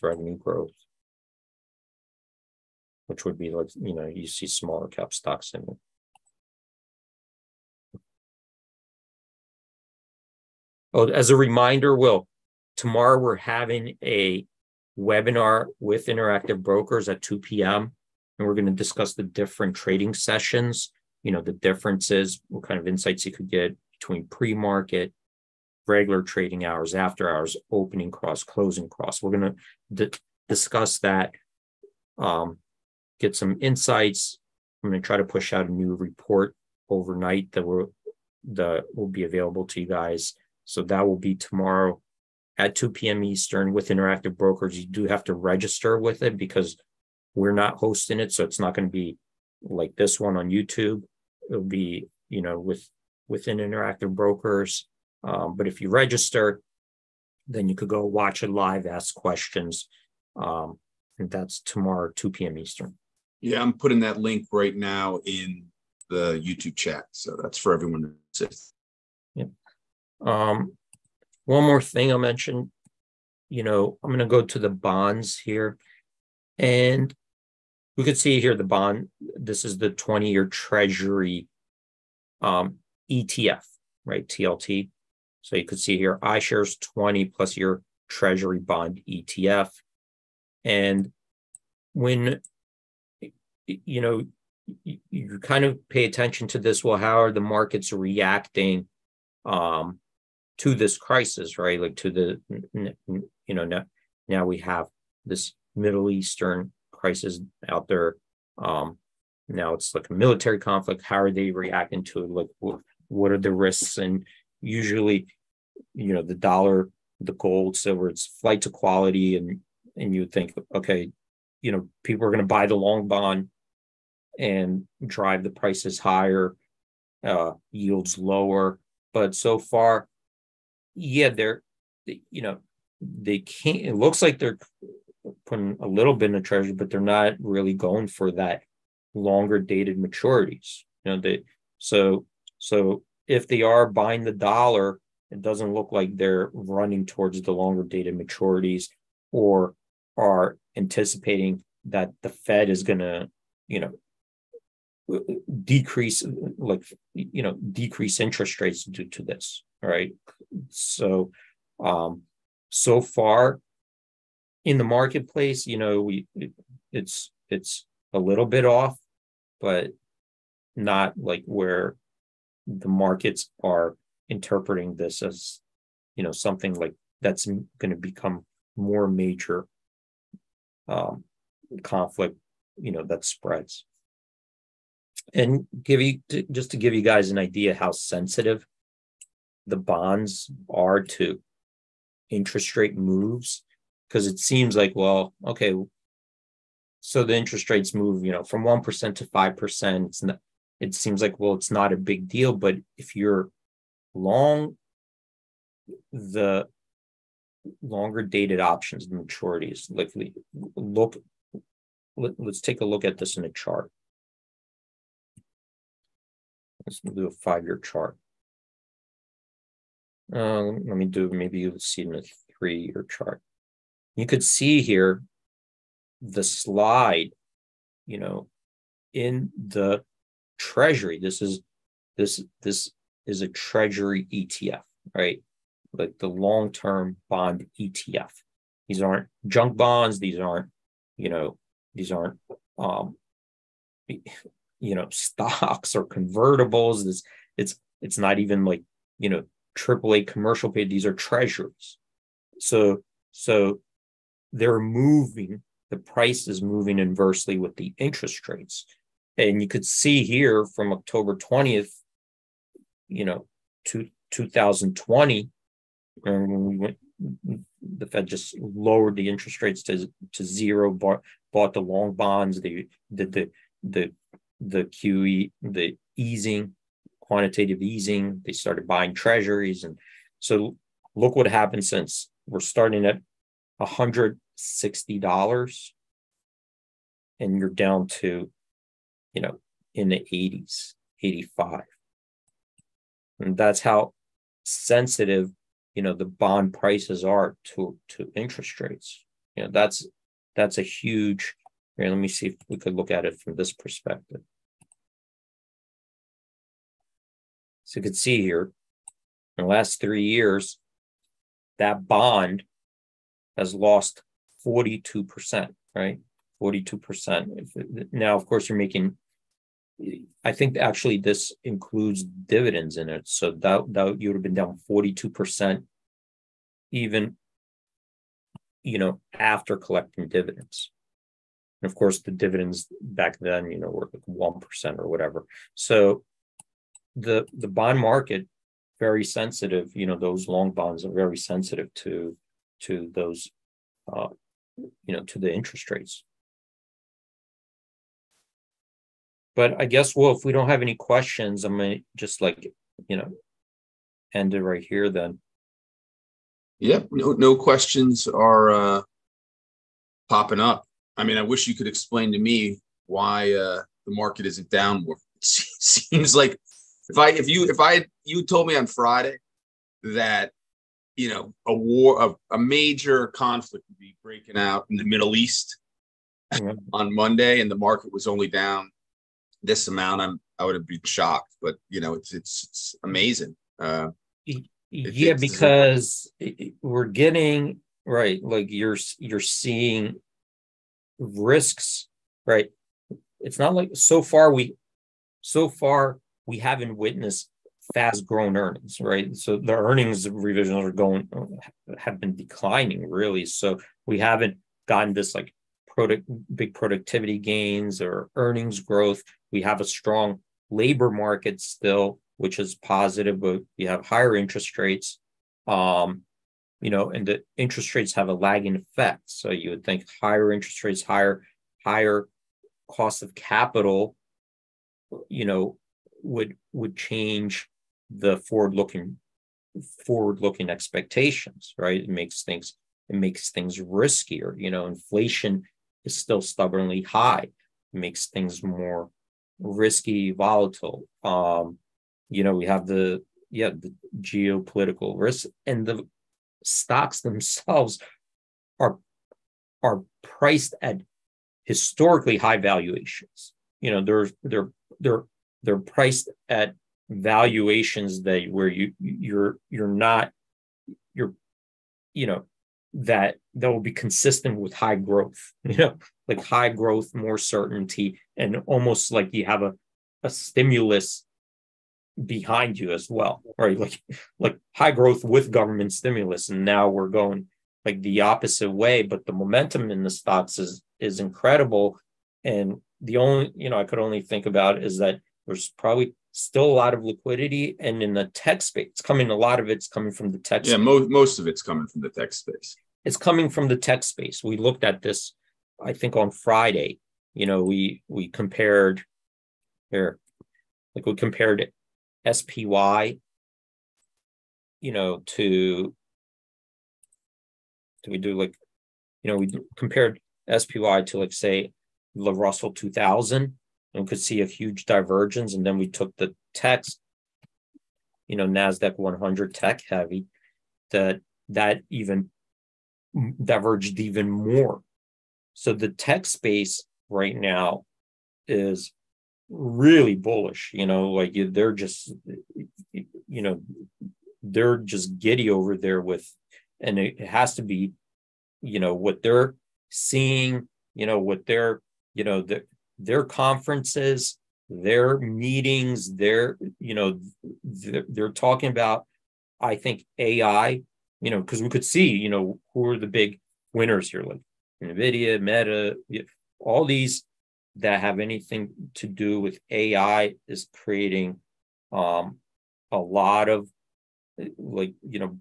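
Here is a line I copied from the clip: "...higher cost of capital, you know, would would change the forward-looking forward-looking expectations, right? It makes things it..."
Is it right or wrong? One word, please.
right.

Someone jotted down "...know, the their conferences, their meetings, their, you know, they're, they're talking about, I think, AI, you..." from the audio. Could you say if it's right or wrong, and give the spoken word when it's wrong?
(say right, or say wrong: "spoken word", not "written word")
right.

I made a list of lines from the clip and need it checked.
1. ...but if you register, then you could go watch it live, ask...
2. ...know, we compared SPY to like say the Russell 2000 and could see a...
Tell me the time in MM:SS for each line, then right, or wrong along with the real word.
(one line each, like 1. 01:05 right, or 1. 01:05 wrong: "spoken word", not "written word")
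1. 00:55 right
2. 08:29 right.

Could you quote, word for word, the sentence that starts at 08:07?
And in the tech space, it's coming a lot of it's coming from the tech.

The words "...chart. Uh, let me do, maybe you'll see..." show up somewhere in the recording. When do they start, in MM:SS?
03:37.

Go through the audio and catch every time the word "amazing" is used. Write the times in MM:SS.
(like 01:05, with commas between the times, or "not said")
06:23.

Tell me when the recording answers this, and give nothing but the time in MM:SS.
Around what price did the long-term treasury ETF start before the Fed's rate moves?
04:43.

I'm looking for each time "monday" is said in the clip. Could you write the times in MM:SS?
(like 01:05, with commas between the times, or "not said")
06:17.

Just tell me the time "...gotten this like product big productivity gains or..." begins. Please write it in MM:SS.
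06:44.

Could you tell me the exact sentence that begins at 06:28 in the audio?
Like you're you're seeing risks, right?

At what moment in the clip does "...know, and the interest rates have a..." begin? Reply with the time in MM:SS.
06:56.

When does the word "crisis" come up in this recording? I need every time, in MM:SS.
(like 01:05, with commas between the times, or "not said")
01:40, 01:46.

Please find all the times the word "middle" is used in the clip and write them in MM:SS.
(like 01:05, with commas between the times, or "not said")
01:45, 06:15.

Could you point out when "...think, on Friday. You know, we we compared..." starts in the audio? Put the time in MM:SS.
08:15.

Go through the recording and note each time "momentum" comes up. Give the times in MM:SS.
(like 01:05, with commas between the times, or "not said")
07:59.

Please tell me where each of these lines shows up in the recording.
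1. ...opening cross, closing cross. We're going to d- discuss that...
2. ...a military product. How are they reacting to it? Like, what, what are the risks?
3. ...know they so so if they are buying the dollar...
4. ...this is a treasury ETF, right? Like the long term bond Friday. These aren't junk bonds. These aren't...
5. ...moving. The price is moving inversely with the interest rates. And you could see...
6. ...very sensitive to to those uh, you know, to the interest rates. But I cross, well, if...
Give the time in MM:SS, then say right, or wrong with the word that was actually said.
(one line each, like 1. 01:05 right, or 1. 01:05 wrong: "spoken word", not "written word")
1. 00:27 right
2. 01:50 wrong: "conflict", not "product"
3. 02:21 right
4. 03:52 wrong: "ETF", not "Friday"
5. 04:14 right
6. 05:41 wrong: "guess", not "cross".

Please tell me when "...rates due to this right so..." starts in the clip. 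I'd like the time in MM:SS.
02:38.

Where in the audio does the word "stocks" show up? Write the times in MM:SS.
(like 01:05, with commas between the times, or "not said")
00:05, 04:05, 07:26, 08:00.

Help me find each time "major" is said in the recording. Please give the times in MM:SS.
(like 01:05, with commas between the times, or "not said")
02:59, 06:12.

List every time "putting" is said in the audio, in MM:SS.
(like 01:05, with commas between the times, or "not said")
01:03, 02:15.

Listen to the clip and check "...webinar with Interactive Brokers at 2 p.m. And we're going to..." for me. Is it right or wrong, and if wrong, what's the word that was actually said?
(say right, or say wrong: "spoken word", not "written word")
right.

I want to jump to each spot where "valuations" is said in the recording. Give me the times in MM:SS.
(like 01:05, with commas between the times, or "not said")
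07:32, 07:37.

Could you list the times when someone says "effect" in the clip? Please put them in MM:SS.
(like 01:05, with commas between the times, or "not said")
06:58.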